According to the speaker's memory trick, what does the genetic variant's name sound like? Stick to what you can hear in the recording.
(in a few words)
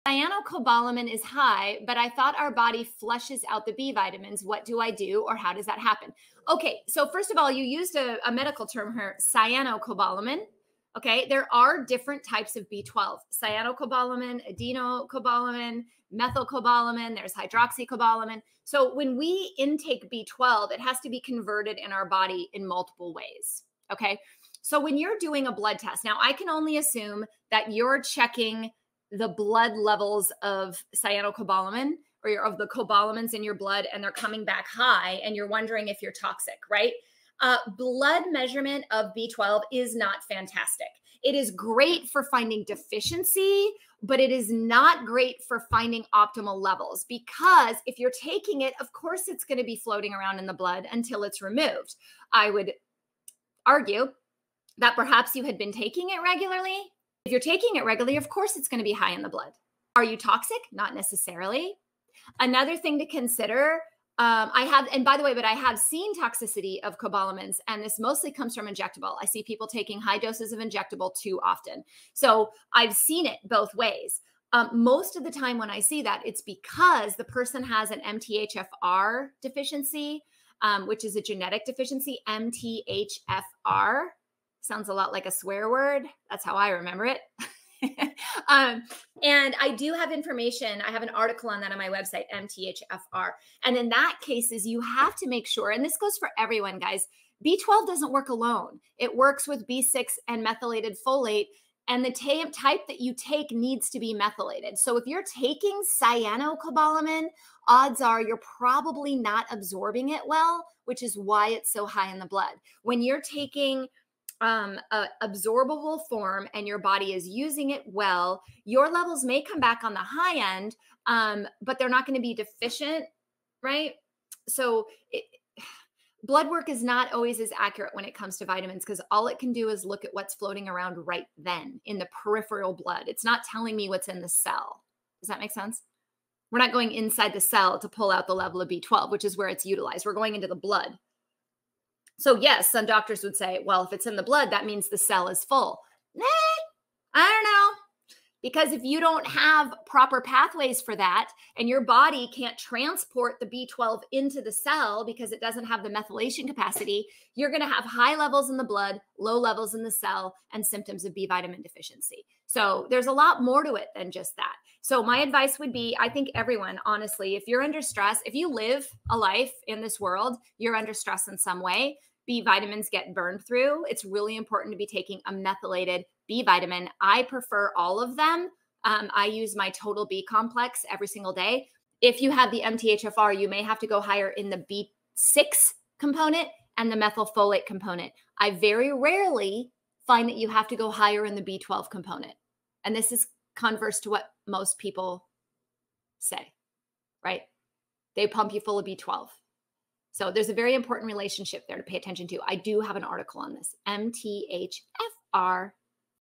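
A swear word.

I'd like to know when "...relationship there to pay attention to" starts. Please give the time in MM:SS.
03:21.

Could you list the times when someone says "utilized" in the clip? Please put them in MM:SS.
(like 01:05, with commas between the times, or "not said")
02:19.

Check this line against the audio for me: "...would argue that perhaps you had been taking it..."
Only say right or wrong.
right.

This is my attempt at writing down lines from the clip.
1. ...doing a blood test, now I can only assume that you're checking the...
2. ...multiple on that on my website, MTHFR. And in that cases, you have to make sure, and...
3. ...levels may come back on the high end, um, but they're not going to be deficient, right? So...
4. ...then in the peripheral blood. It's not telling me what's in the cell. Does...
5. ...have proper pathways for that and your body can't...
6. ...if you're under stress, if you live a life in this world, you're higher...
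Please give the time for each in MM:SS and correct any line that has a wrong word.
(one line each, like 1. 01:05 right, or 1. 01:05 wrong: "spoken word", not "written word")
1. 00:25 right
2. 01:31 wrong: "article", not "multiple"
3. 01:58 right
4. 02:11 right
5. 02:29 right
6. 02:47 wrong: "under", not "higher".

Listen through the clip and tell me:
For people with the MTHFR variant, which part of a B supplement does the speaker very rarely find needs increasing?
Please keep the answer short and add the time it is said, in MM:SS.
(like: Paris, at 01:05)
The B12 component, at 03:11.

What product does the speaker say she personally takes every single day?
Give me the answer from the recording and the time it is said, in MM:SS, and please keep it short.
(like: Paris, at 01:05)
Total B complex, at 02:59.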